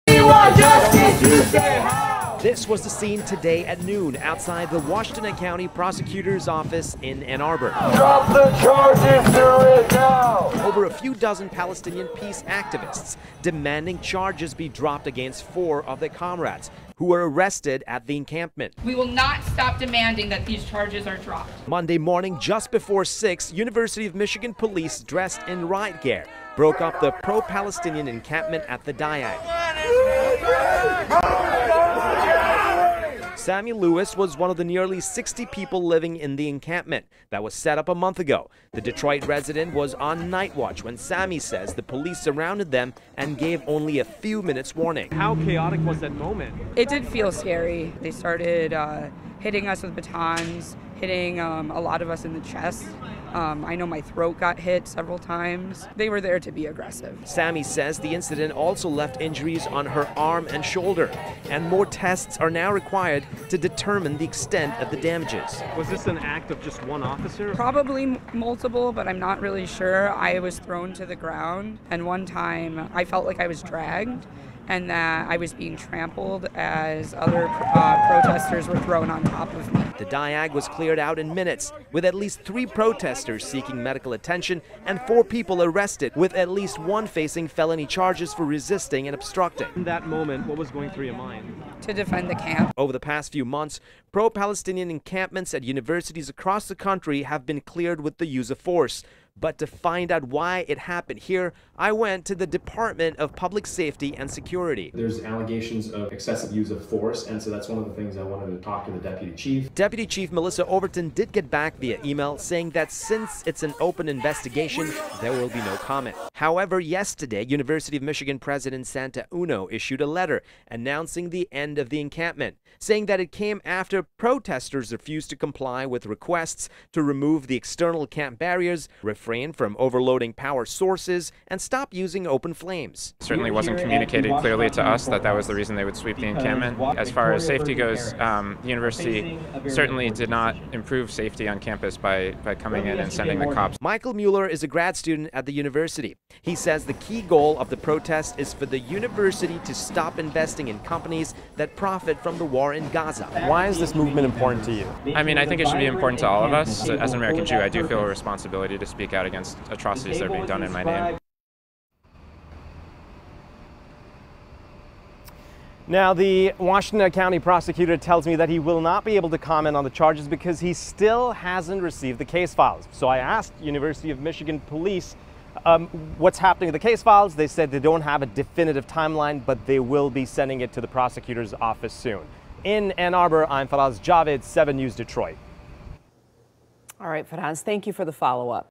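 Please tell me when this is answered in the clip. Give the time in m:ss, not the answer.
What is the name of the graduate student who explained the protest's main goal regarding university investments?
2:23.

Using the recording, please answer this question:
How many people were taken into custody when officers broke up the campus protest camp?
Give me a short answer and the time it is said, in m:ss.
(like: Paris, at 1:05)
4, at 1:25.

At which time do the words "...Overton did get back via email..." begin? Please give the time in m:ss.
1:50.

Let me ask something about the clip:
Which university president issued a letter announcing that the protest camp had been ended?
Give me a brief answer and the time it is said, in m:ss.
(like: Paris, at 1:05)
Santa Ono, at 1:58.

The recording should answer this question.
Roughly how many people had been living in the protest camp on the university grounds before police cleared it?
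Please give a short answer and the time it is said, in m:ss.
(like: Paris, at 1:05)
nearly 60, at 0:34.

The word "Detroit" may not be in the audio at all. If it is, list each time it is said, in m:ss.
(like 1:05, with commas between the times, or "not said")
0:38, 3:04.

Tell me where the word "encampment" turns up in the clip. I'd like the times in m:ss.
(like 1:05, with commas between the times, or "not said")
0:18, 0:28, 0:36, 1:34, 2:02, 2:16.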